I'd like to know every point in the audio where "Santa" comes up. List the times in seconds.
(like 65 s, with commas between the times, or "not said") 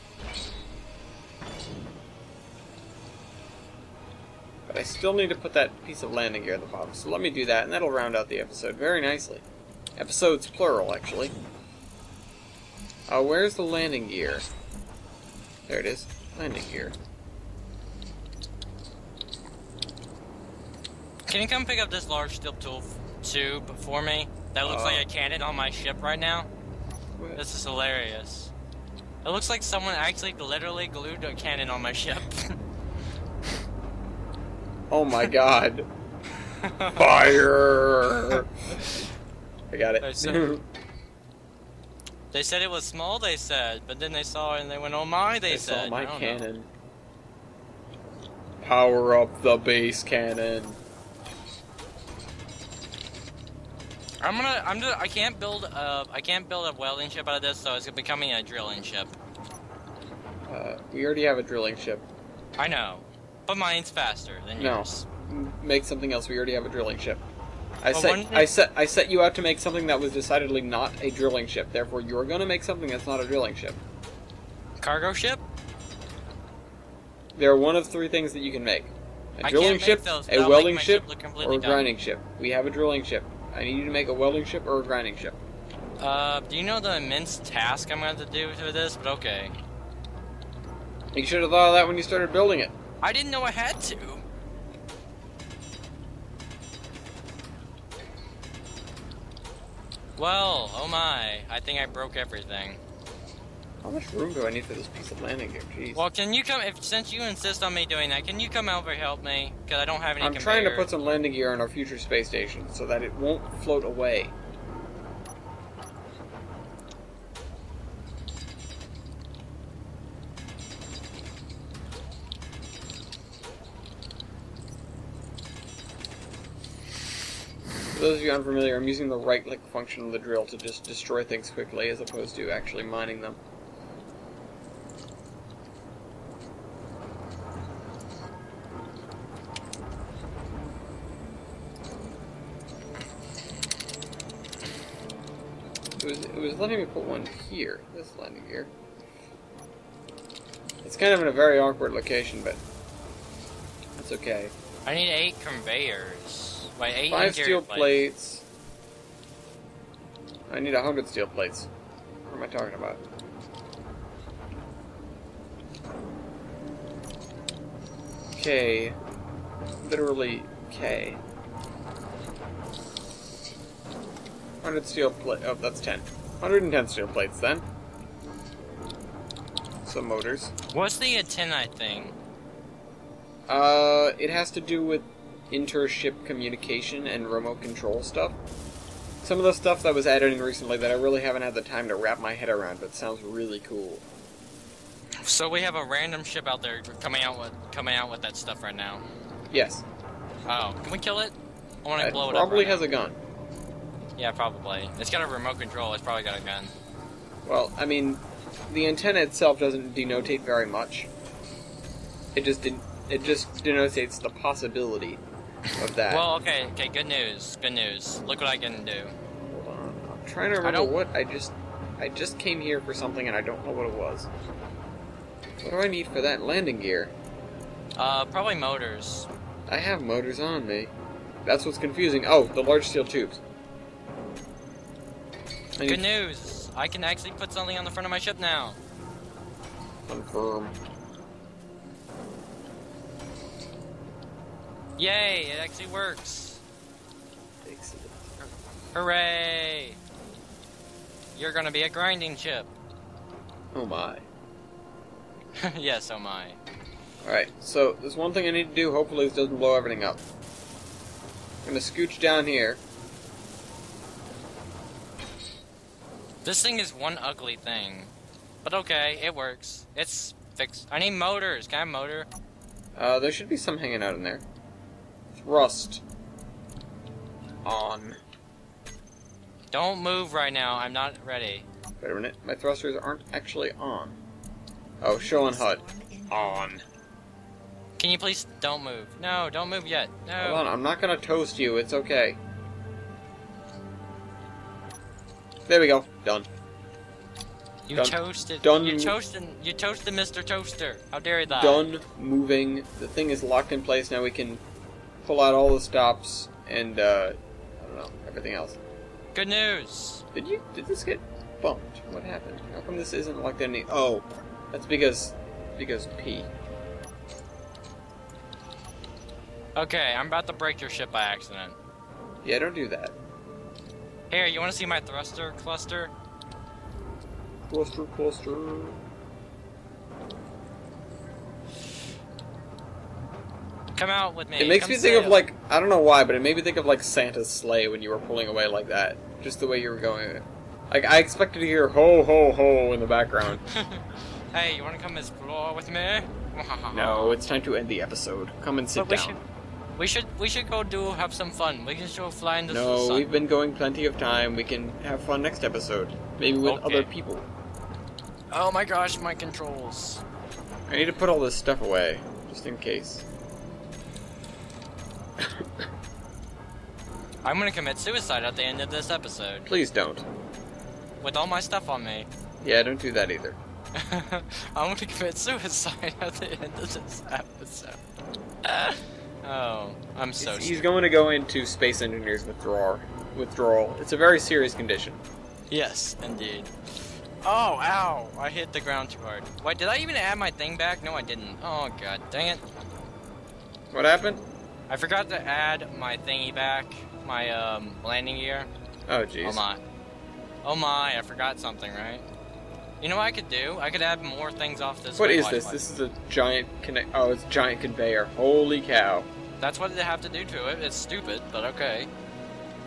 337 s.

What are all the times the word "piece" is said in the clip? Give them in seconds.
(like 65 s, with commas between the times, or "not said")
5 s, 104 s.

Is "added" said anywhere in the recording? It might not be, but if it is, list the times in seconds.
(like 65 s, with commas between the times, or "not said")
190 s.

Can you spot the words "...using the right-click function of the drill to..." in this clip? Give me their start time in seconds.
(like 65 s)
128 s.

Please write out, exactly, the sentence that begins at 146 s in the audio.
was letting me put one here, this landing gear.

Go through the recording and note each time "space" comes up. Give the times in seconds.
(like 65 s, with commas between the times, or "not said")
111 s, 381 s.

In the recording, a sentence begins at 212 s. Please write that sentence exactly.
It just de- it just denotates the possibility of that.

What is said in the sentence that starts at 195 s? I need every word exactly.
So we have a random ship out there coming out with coming out with that stuff right now.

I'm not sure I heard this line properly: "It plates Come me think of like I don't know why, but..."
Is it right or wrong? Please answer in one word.
wrong.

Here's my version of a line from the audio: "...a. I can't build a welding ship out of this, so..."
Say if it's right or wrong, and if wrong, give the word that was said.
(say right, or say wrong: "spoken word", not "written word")
right.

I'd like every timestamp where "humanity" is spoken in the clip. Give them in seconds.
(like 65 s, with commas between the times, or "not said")
not said.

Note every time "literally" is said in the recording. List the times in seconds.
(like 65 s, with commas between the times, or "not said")
30 s, 169 s.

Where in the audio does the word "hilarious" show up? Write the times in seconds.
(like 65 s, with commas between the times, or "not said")
27 s.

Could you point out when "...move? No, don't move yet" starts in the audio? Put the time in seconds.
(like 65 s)
288 s.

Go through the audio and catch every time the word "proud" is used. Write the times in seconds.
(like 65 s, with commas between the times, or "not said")
not said.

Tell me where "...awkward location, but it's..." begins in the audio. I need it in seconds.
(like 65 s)
151 s.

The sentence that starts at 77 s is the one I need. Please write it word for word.
There are one of three things that you can make: a drilling ship, a welding ship, ship or a grinding ship.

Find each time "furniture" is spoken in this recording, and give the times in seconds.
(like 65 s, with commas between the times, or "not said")
not said.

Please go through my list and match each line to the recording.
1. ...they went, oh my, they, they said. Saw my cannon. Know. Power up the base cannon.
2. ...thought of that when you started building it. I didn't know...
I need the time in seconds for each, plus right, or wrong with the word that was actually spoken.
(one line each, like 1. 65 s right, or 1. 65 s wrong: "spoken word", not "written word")
1. 44 s right
2. 91 s right.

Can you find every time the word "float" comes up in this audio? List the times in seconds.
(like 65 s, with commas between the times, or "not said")
113 s.